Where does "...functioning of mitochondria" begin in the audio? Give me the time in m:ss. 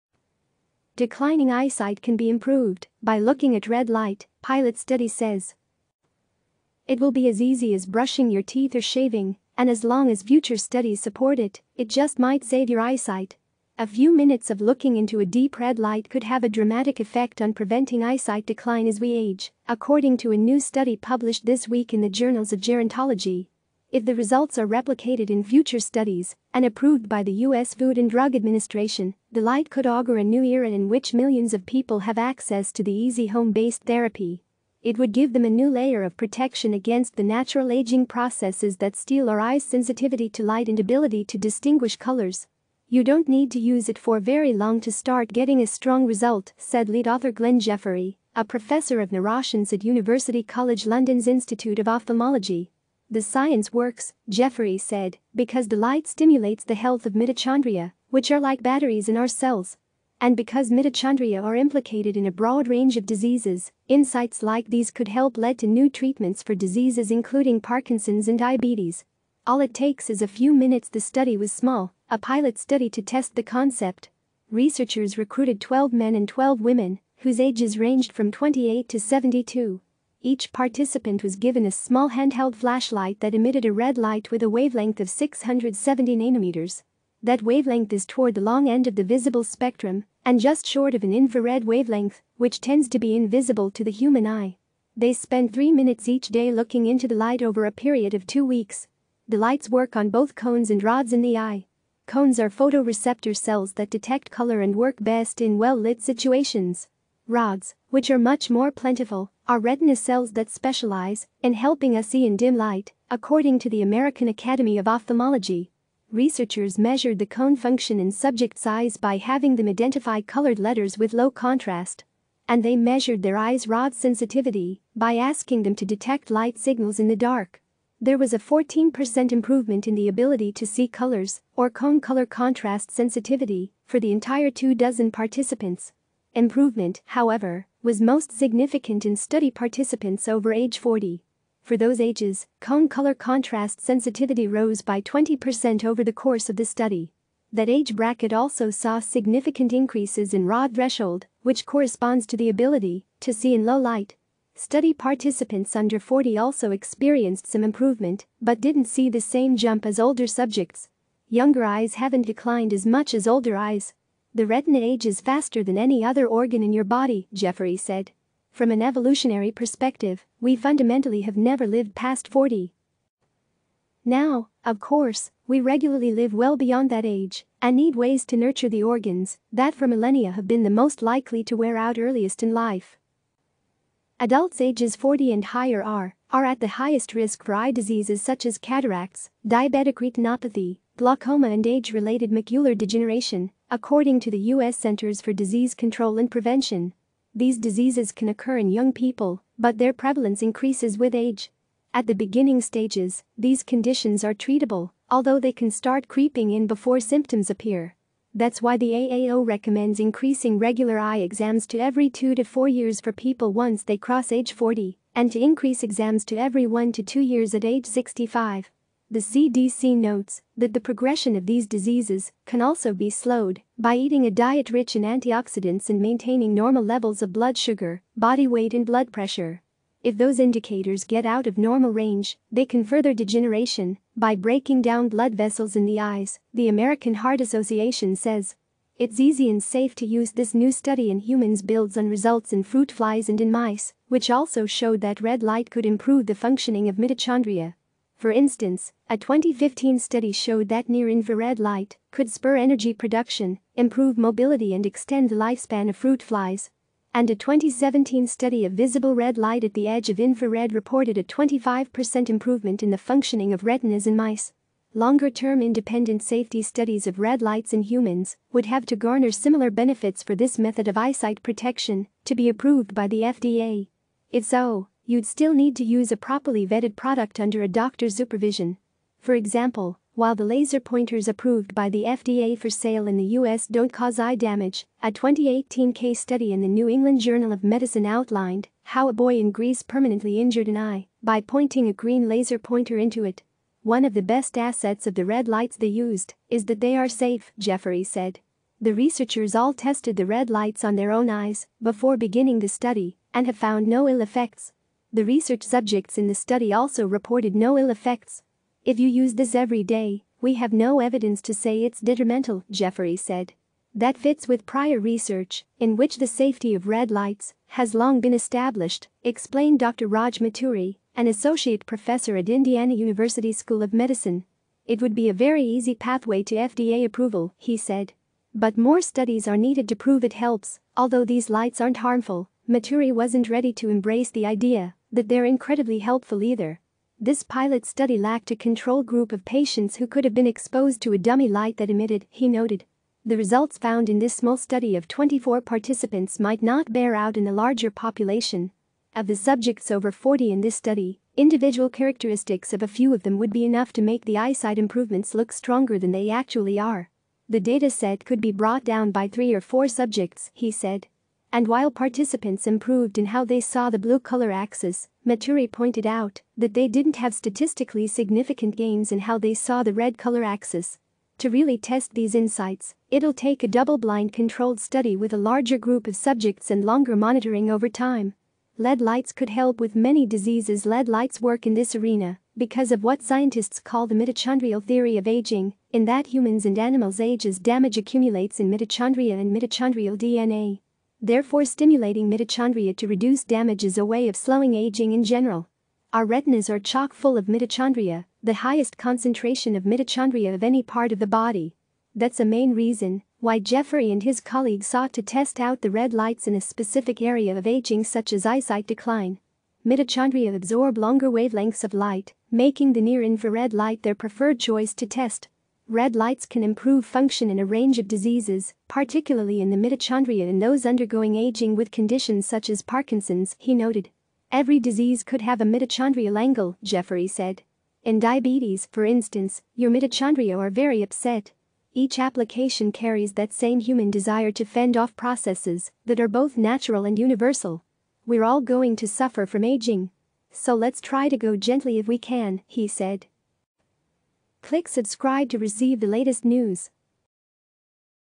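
4:06.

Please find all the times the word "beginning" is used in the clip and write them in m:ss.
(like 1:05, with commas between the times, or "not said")
3:22, 5:02.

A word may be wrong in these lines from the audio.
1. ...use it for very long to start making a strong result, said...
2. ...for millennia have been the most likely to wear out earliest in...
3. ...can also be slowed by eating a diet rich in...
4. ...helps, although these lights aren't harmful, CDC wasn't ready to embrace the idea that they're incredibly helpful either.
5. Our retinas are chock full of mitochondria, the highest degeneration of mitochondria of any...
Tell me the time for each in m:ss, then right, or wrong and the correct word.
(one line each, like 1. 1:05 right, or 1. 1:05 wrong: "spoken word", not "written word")
1. 0:43 wrong: "getting", not "making"
2. 2:59 right
3. 3:42 right
4. 5:30 wrong: "Maturi", not "CDC"
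5. 6:36 wrong: "concentration", not "degeneration".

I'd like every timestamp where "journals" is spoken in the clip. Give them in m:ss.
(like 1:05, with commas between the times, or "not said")
0:22, 4:47.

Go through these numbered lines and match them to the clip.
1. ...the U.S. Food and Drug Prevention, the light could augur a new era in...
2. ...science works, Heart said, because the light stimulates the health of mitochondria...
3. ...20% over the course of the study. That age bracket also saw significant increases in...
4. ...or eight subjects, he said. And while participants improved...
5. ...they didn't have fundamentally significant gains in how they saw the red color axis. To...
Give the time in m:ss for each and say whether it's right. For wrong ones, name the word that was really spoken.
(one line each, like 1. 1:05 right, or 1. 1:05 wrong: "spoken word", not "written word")
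1. 0:27 wrong: "Administration", not "Prevention"
2. 0:53 wrong: "Jeffery", not "Heart"
3. 2:25 right
4. 5:59 wrong: "four", not "eight"
5. 6:06 wrong: "statistically", not "fundamentally".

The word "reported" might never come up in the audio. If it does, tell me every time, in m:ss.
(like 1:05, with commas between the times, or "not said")
4:20, 5:07.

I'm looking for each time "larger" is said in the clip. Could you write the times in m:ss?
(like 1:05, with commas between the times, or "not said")
5:47, 6:15.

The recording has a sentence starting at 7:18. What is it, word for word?
We're all going to suffer from aging.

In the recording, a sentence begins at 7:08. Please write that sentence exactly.
In diabetes, for instance, your mitochondria are very upset.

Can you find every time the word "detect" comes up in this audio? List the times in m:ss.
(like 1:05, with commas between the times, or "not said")
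1:43, 2:05.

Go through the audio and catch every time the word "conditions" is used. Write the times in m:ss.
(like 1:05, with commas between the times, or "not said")
3:23, 7:01.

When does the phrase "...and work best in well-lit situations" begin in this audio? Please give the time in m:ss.
1:44.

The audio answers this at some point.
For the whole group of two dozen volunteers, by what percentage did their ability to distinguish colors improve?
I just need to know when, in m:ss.
2:08.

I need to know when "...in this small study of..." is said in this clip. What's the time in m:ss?
5:44.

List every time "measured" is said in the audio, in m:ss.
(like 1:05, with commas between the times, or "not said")
1:56, 2:02.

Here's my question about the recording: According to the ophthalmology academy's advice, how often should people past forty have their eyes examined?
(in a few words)
every 2 to 4 years.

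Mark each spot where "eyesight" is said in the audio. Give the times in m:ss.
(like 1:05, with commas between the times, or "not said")
0:01, 0:12, 0:18, 4:30, 5:54, 6:48.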